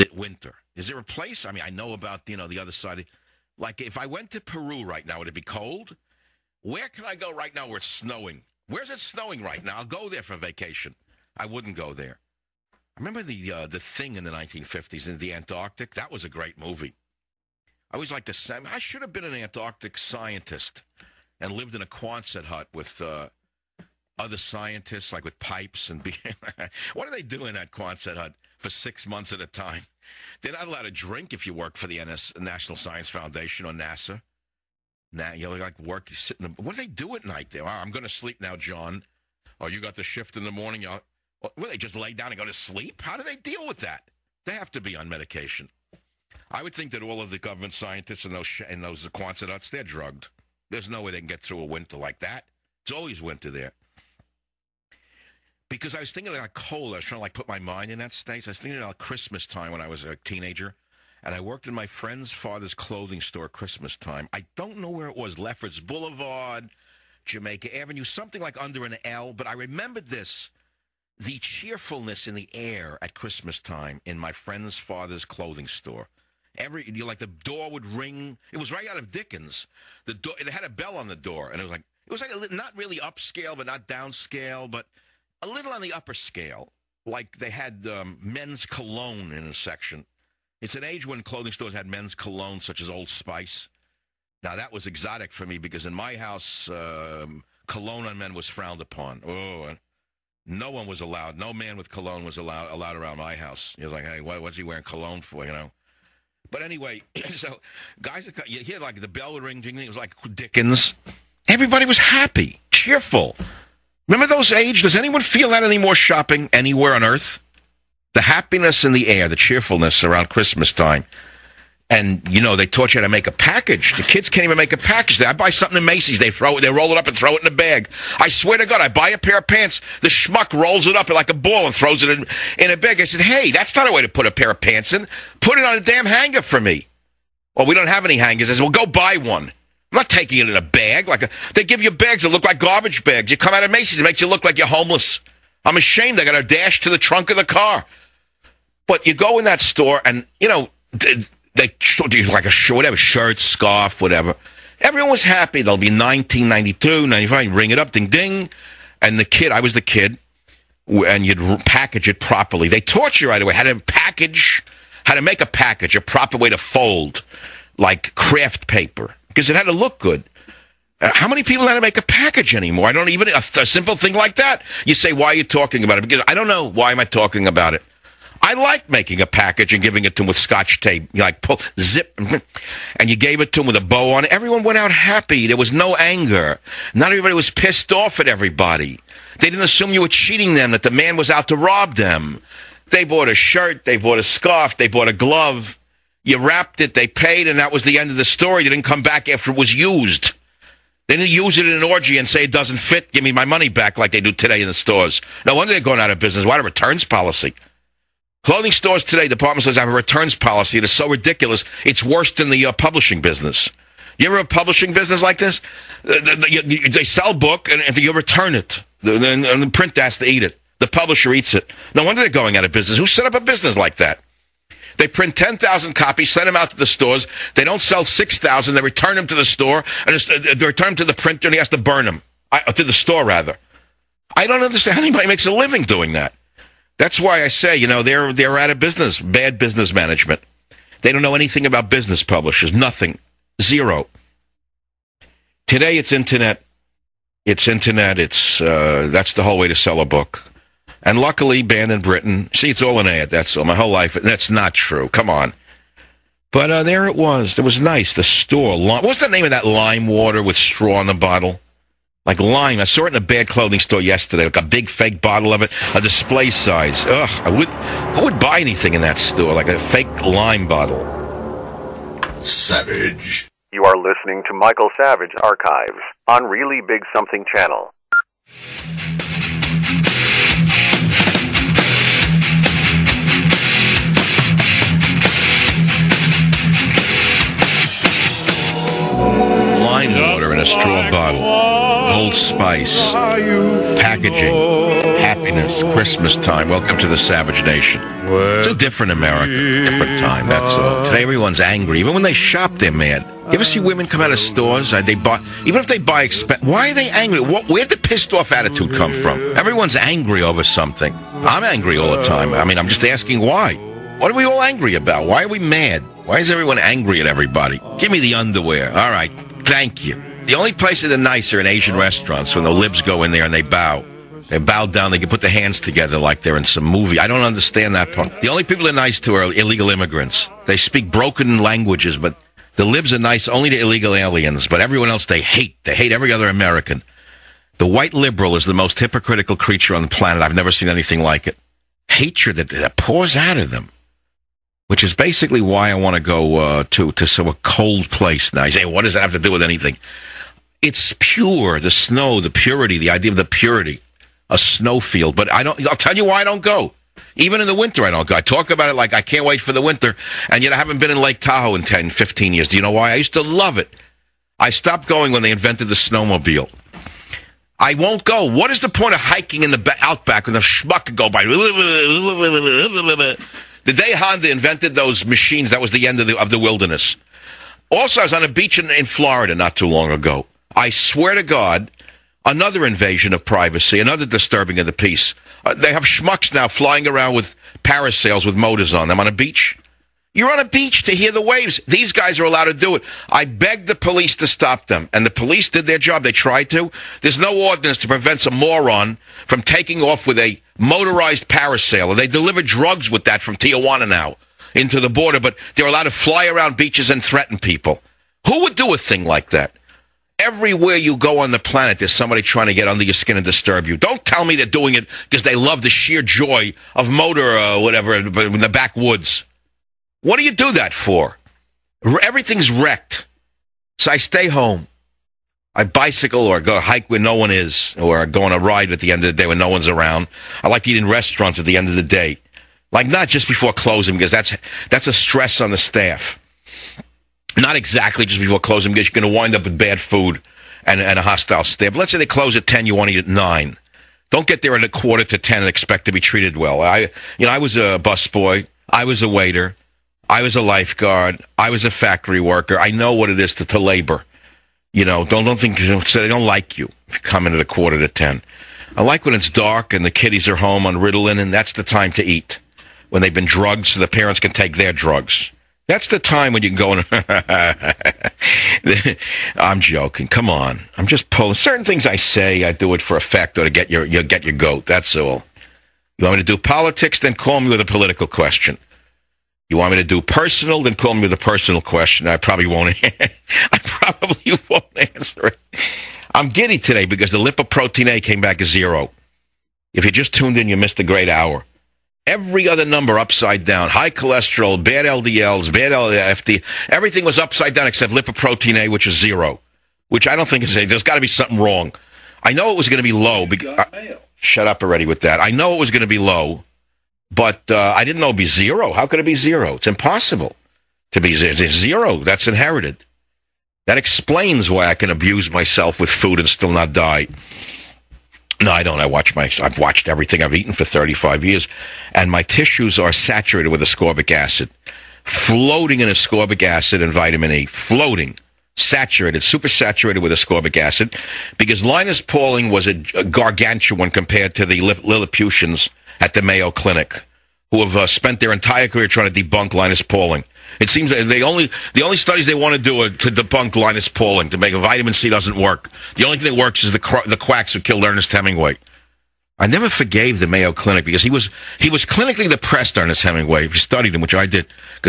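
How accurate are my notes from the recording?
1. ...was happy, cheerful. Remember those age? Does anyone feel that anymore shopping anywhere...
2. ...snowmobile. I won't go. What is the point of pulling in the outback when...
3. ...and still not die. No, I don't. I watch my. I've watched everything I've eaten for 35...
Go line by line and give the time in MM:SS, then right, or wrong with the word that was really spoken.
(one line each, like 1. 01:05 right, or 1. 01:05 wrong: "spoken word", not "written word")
1. 01:51 right
2. 06:05 wrong: "hiking", not "pulling"
3. 08:36 right.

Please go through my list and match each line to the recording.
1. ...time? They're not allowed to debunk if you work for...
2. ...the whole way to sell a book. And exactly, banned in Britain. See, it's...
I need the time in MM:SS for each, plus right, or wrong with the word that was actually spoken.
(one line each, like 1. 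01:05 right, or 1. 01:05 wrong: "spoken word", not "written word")
1. 00:29 wrong: "drink", not "debunk"
2. 04:09 wrong: "luckily", not "exactly".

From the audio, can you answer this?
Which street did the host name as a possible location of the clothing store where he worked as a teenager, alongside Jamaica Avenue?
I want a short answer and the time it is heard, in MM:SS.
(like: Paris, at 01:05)
Lefferts Boulevard, at 01:05.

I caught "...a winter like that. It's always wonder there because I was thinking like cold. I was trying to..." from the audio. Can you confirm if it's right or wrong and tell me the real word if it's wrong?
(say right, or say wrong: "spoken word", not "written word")
wrong: "winter", not "wonder".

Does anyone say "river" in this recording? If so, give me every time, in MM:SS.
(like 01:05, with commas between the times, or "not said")
not said.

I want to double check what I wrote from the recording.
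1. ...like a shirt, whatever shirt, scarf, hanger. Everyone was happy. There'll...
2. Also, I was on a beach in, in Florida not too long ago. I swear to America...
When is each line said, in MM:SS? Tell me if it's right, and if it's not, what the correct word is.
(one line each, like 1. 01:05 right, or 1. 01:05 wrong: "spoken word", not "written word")
1. 02:32 wrong: "whatever", not "hanger"
2. 06:17 wrong: "God", not "America".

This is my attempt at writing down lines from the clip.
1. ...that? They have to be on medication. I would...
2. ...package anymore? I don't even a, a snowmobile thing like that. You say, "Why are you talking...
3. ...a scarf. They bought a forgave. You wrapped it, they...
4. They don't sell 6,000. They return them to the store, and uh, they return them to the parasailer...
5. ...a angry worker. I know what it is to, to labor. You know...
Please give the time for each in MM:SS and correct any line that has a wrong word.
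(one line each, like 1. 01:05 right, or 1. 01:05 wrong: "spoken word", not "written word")
1. 00:43 right
2. 02:52 wrong: "simple", not "snowmobile"
3. 03:14 wrong: "glove", not "forgave"
4. 03:47 wrong: "printer", not "parasailer"
5. 07:31 wrong: "factory", not "angry".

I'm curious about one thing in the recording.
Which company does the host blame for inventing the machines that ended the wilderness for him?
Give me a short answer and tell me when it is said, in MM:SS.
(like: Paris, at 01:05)
Honda, at 06:14.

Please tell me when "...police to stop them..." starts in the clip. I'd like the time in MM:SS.
06:33.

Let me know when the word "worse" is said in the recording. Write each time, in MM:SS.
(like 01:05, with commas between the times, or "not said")
03:32.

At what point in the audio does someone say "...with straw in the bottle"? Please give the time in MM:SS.
04:20.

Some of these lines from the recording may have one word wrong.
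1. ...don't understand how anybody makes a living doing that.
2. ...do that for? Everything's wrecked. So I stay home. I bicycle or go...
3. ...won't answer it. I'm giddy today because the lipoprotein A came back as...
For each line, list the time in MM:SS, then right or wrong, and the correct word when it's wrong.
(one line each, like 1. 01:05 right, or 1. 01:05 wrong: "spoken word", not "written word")
1. 03:54 right
2. 07:00 right
3. 08:04 right.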